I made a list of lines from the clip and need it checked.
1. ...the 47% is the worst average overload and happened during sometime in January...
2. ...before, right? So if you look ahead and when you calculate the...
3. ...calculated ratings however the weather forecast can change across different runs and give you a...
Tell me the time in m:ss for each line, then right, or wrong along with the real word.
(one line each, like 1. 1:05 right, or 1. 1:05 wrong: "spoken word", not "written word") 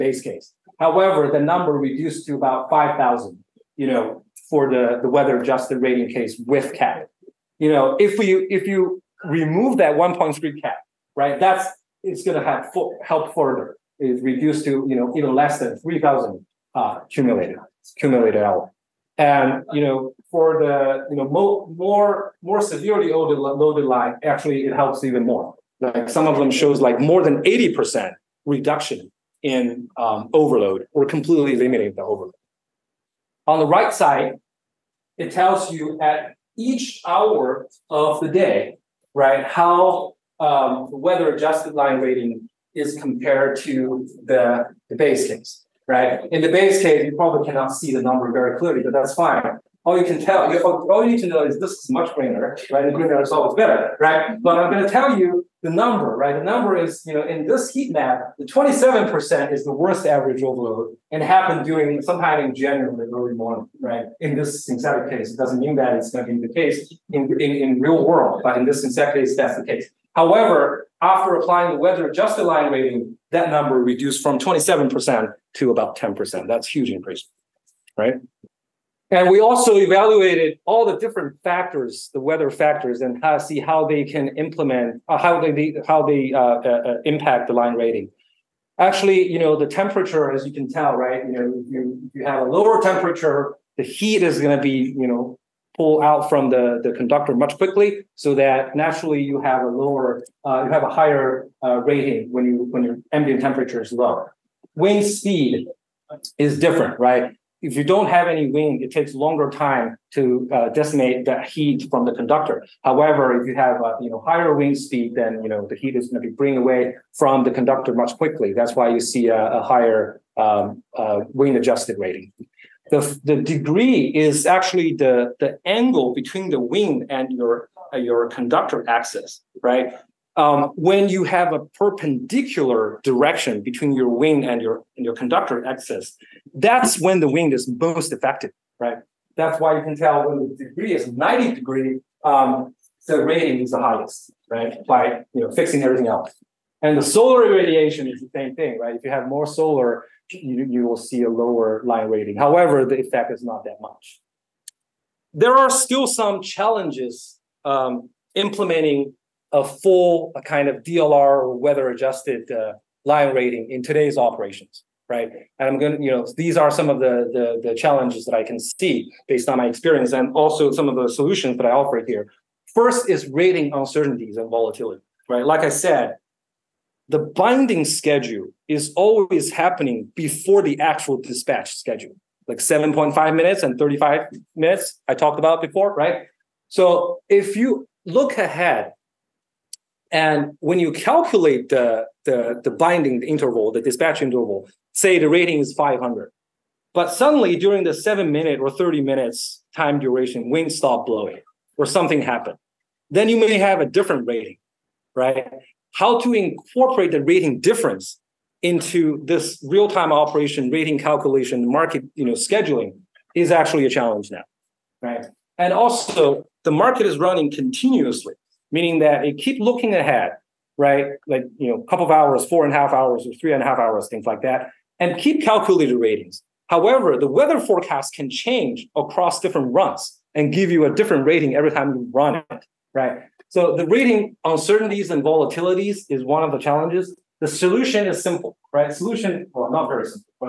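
1. 0:58 wrong: "27", not "47"
2. 3:05 right
3. 3:45 right.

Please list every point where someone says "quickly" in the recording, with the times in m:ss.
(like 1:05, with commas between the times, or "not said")
1:37, 1:58.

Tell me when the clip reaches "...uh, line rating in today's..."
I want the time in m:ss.
2:42.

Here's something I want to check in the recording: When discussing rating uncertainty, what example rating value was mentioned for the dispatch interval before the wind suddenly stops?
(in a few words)
500.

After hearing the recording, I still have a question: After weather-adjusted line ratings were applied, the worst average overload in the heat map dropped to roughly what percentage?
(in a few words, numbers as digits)
About 10%.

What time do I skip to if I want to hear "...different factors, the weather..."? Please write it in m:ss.
1:20.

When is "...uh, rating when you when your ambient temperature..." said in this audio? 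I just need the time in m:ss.
1:41.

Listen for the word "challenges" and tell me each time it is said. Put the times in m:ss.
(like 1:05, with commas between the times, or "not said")
2:36, 2:47, 3:33, 3:56.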